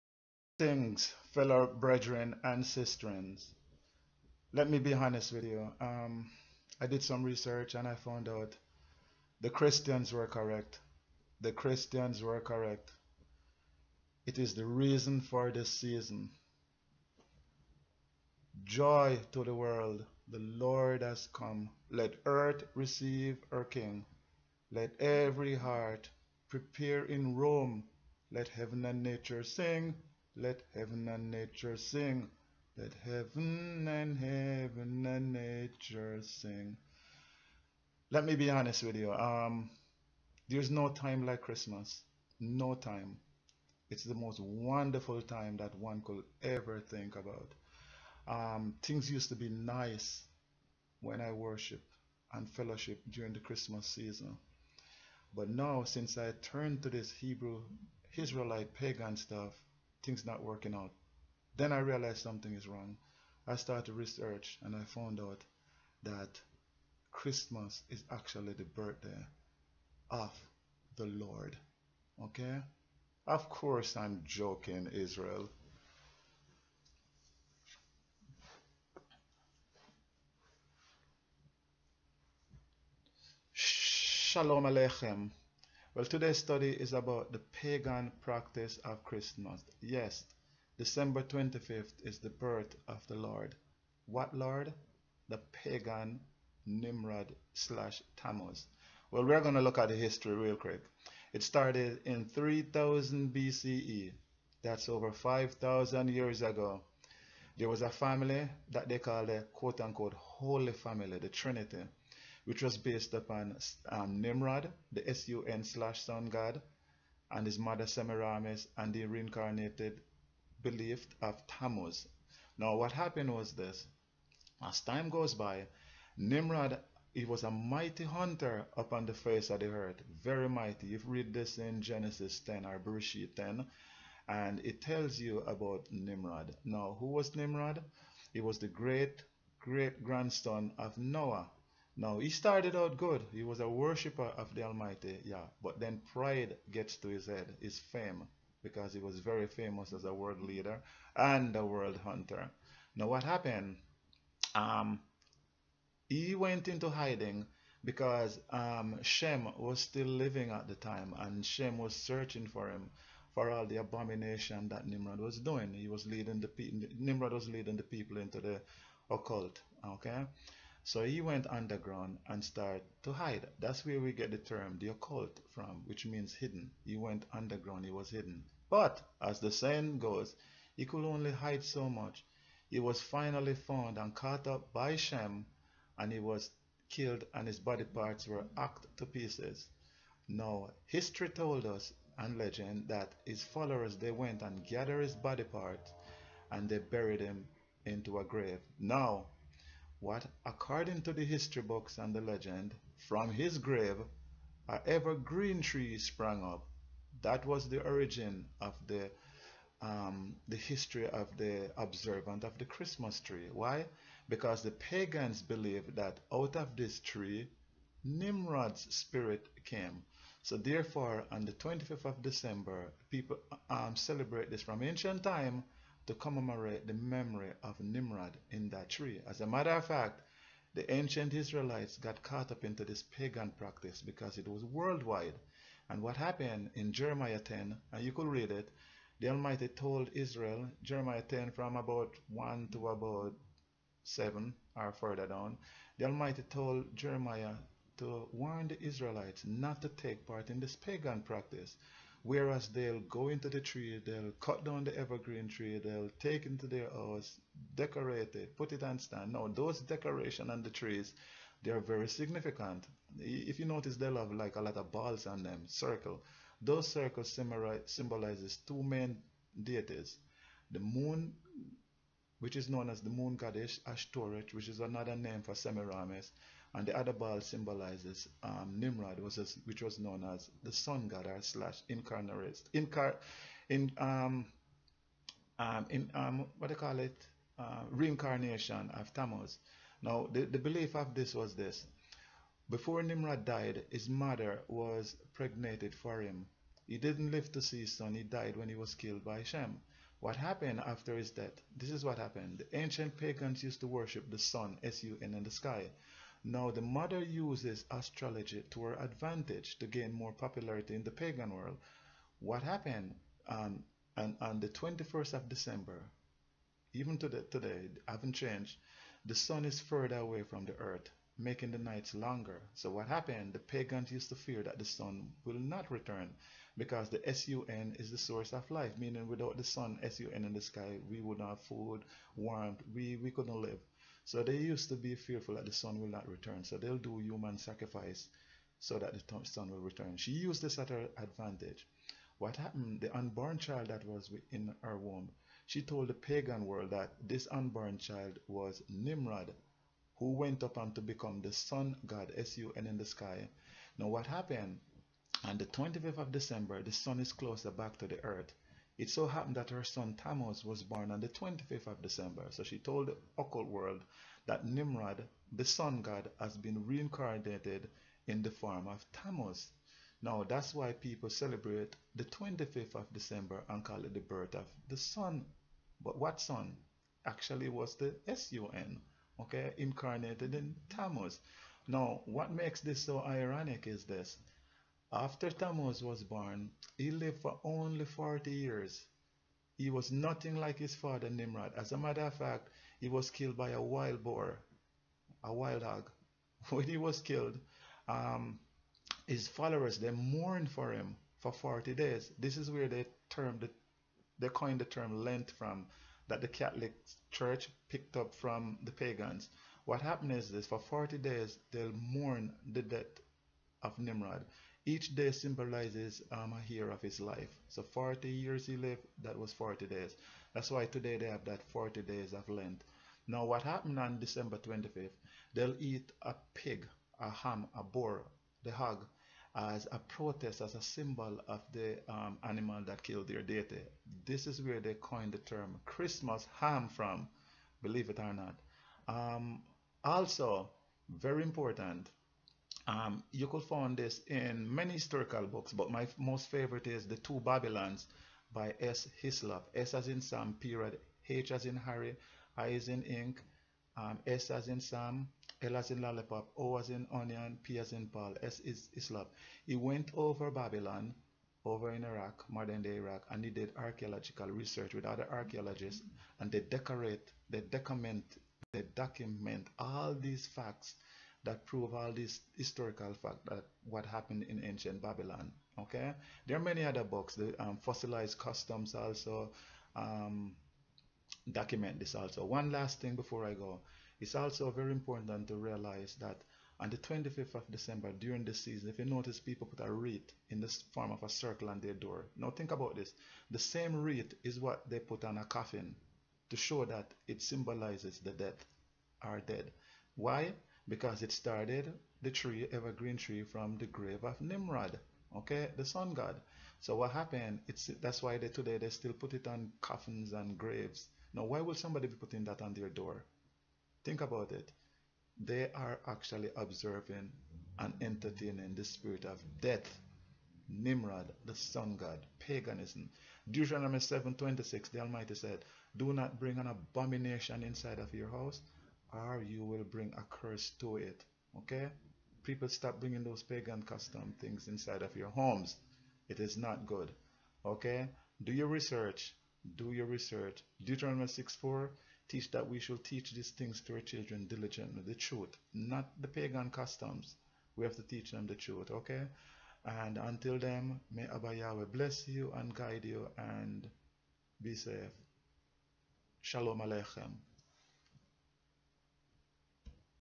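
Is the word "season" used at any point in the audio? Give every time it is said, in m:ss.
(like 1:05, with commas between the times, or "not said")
0:15, 0:53, 8:08.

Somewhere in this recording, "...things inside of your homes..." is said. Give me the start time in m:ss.
8:54.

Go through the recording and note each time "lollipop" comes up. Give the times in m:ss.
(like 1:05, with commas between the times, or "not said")
7:36.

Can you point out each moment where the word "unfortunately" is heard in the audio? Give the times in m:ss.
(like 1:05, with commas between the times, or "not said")
not said.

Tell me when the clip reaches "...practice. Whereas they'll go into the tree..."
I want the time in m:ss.
4:11.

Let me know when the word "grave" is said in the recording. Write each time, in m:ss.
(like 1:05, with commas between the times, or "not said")
3:18, 3:23, 8:23, 8:30.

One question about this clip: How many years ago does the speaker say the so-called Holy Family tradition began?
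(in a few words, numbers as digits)
over 5,000 years.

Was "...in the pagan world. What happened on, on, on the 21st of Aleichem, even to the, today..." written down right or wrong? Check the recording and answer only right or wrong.
wrong.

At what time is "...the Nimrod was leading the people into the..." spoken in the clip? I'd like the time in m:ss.
2:46.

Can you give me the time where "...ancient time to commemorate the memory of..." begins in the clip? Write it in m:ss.
3:44.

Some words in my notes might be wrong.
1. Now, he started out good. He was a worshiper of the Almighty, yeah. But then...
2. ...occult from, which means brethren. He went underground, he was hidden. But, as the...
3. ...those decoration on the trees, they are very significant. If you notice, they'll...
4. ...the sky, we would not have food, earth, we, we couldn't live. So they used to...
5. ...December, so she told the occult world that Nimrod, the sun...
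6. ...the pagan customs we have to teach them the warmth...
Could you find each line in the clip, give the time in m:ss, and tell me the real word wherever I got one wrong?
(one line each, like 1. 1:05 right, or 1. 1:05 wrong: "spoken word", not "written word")
1. 2:22 right
2. 2:54 wrong: "hidden", not "brethren"
3. 4:19 right
4. 5:30 wrong: "warmth", not "earth"
5. 6:02 right
6. 9:06 wrong: "truth", not "warmth".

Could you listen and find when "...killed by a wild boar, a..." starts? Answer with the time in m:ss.
6:33.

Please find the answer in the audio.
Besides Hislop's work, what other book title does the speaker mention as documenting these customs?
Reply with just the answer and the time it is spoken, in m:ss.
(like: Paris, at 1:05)
Fossilized Customs, at 7:57.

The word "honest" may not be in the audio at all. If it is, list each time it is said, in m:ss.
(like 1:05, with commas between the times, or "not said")
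0:04, 0:38.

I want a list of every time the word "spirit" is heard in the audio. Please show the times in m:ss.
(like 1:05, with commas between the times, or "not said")
3:38, 8:38.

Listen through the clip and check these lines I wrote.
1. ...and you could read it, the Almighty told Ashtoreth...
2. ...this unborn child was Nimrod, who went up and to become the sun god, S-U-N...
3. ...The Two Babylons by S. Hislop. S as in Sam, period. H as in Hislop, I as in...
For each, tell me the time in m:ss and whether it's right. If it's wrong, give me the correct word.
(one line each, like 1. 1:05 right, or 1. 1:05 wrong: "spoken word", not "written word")
1. 3:57 wrong: "Israel", not "Ashtoreth"
2. 5:47 right
3. 7:27 wrong: "Harry", not "Hislop".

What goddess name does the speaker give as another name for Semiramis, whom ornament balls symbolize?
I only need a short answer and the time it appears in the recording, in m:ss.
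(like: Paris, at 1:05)
Ashtoreth, at 4:33.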